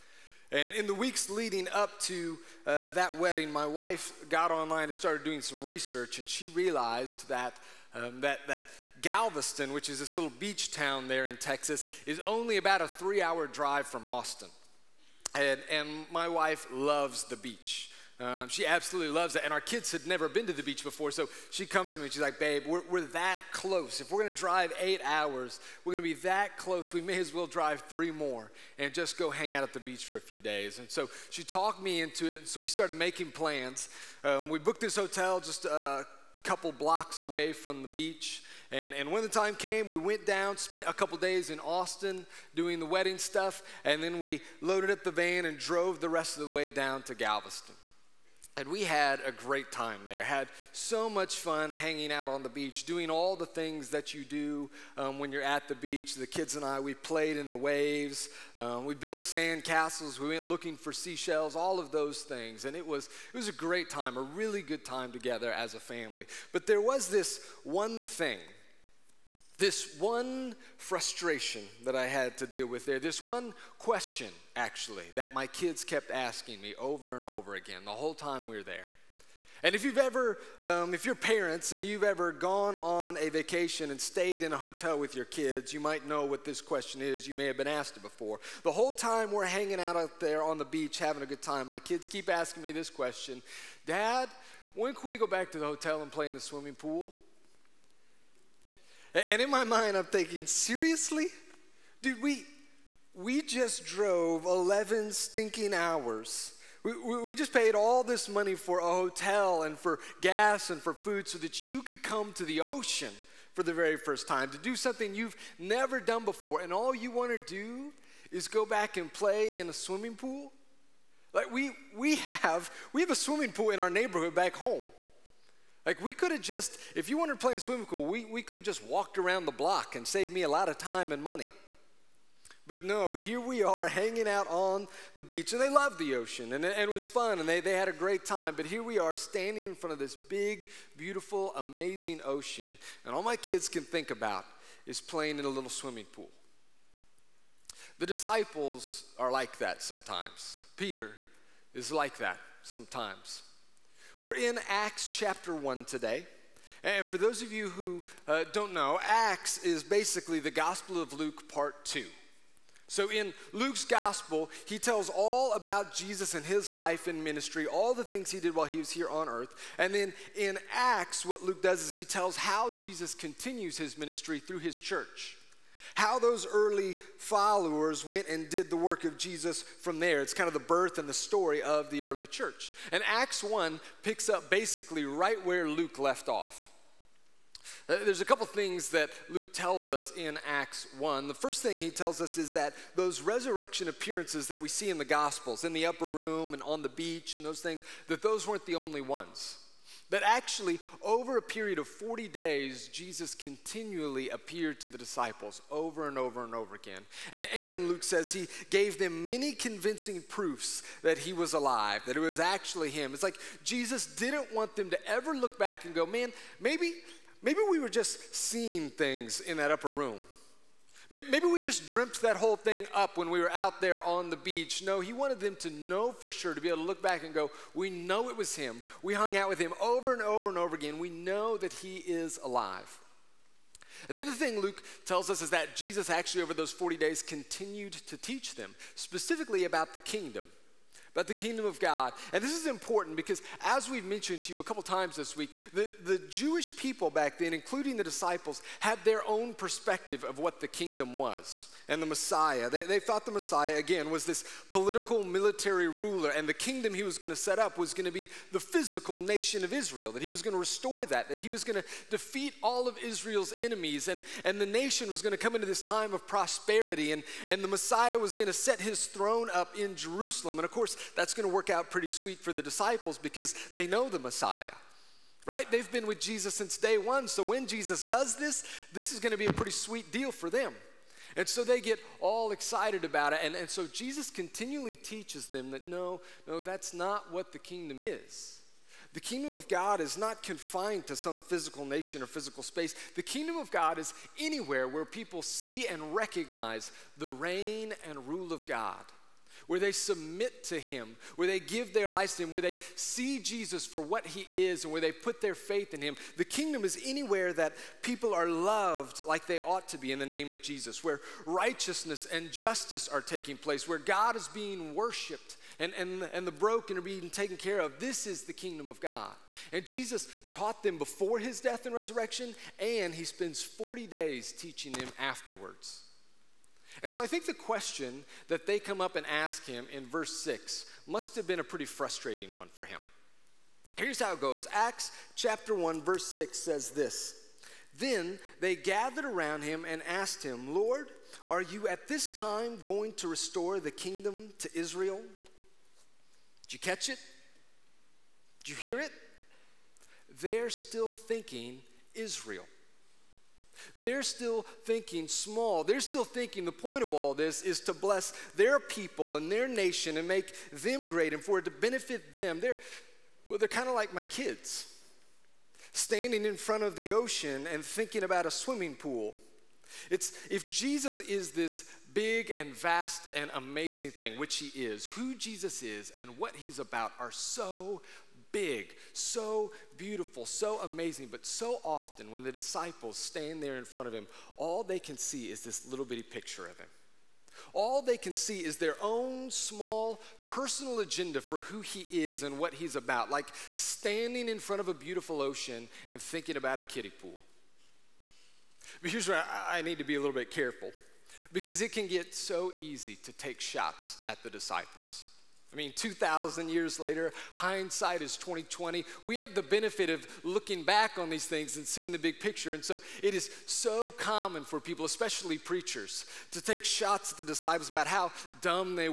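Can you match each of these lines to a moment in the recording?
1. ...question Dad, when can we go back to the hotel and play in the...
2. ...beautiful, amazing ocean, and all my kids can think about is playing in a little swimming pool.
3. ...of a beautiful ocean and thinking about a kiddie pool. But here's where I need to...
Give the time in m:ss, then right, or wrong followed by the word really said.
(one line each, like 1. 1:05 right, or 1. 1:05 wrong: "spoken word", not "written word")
1. 1:32 right
2. 2:20 right
3. 6:34 right.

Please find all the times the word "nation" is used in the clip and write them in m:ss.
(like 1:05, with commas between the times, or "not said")
4:19, 4:24, 4:51, 5:59.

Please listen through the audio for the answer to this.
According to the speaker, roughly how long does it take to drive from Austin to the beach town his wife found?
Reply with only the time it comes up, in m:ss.
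0:12.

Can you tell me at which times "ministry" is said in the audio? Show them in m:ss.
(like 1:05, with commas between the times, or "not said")
2:47, 2:53.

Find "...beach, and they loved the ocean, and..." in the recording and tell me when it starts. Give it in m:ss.
2:15.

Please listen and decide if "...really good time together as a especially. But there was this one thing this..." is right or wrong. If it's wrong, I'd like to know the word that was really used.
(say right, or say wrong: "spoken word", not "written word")
wrong: "family", not "especially".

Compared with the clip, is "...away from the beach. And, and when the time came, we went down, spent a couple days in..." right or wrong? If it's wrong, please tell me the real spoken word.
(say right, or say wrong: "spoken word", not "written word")
right.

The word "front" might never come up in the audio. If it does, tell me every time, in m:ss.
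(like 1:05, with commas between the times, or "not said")
2:19, 6:06, 6:23, 6:34.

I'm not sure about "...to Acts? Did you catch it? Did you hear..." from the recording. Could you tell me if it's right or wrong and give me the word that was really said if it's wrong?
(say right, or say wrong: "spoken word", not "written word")
wrong: "Israel", not "Acts".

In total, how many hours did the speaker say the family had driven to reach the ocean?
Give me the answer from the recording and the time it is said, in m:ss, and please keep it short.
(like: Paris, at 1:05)
11, at 1:44.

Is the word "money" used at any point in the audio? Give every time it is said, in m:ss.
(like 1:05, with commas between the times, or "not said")
1:48, 2:11.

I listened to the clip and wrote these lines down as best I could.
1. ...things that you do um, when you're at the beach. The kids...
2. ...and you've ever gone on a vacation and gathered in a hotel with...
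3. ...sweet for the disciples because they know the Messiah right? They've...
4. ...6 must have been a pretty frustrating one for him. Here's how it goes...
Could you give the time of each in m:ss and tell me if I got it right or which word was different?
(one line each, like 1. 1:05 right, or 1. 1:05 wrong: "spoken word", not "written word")
1. 0:53 right
2. 1:21 wrong: "stayed", not "gathered"
3. 4:32 right
4. 5:30 right.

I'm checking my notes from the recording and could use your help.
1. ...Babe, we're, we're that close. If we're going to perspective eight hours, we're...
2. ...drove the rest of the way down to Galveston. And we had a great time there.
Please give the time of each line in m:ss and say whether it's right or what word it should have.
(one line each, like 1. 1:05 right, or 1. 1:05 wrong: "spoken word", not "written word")
1. 0:22 wrong: "drive", not "perspective"
2. 0:45 right.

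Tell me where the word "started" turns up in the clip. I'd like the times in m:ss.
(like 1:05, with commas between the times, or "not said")
0:04, 0:32.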